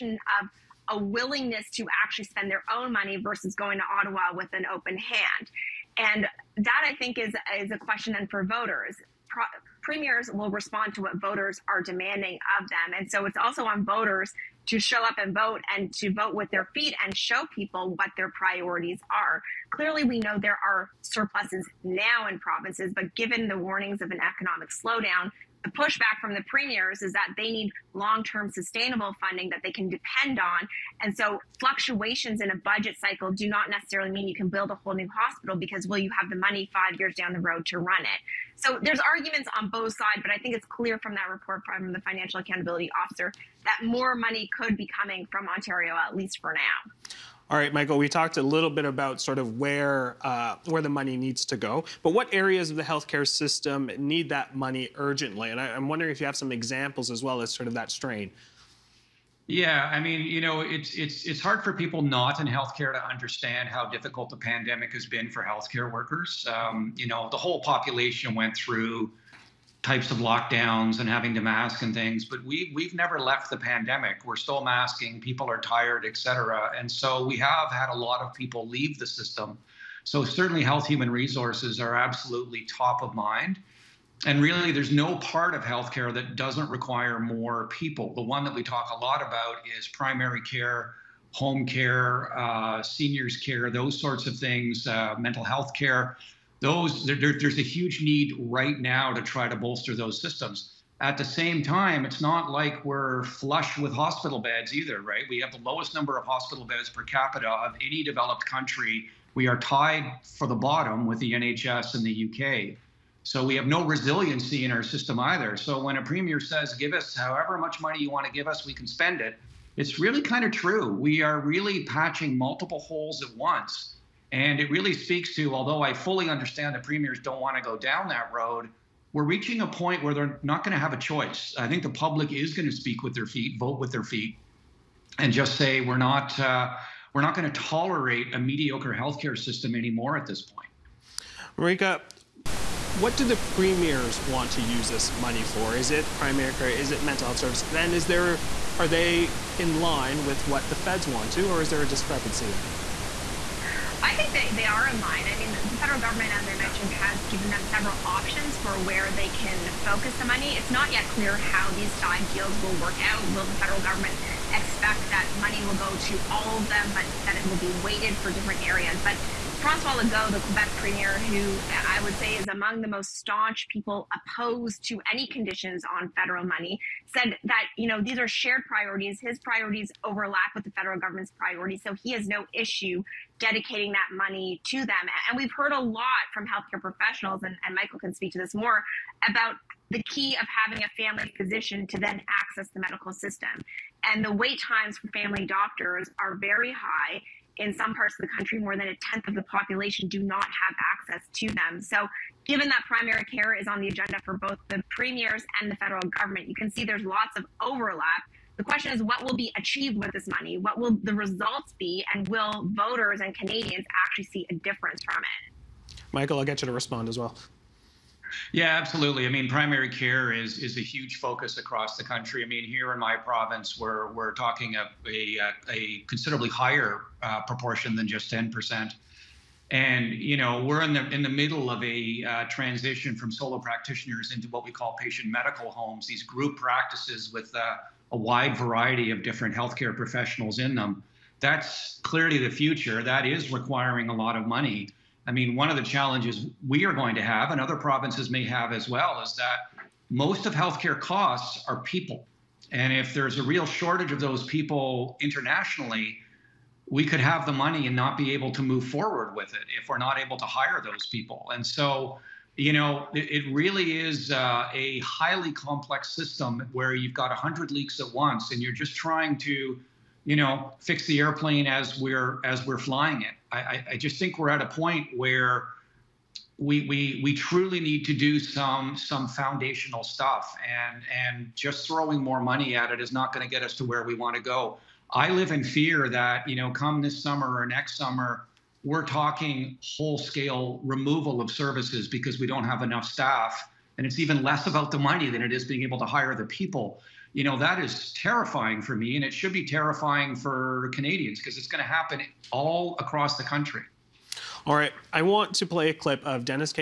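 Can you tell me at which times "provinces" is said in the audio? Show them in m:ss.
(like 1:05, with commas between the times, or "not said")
0:22, 3:43, 4:07.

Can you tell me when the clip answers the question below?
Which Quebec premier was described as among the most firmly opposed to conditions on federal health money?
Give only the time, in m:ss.
2:49.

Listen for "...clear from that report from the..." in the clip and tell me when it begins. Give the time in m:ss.
0:40.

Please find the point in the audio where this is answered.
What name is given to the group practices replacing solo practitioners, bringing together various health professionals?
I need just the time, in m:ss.
3:54.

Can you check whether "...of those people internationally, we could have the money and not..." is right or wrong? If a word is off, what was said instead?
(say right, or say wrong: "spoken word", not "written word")
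right.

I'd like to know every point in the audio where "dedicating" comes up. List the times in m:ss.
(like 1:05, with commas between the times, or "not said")
3:03.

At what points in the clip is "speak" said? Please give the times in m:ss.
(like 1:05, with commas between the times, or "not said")
2:04, 2:12, 3:08.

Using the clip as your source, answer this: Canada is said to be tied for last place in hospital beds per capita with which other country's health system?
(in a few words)
The NHS in the UK.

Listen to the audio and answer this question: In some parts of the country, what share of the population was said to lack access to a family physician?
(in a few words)
More than a tenth.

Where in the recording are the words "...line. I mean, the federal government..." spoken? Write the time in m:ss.
2:34.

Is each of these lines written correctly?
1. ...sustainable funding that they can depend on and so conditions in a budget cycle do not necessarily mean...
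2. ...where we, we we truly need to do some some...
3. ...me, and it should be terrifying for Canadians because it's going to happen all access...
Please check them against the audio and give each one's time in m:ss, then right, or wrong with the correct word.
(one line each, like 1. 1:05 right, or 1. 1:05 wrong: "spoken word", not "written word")
1. 0:28 wrong: "fluctuations", not "conditions"
2. 4:35 right
3. 4:58 wrong: "across", not "access".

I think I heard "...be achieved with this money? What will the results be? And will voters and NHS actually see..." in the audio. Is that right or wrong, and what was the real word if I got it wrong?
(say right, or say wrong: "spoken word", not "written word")
wrong: "Canadians", not "NHS".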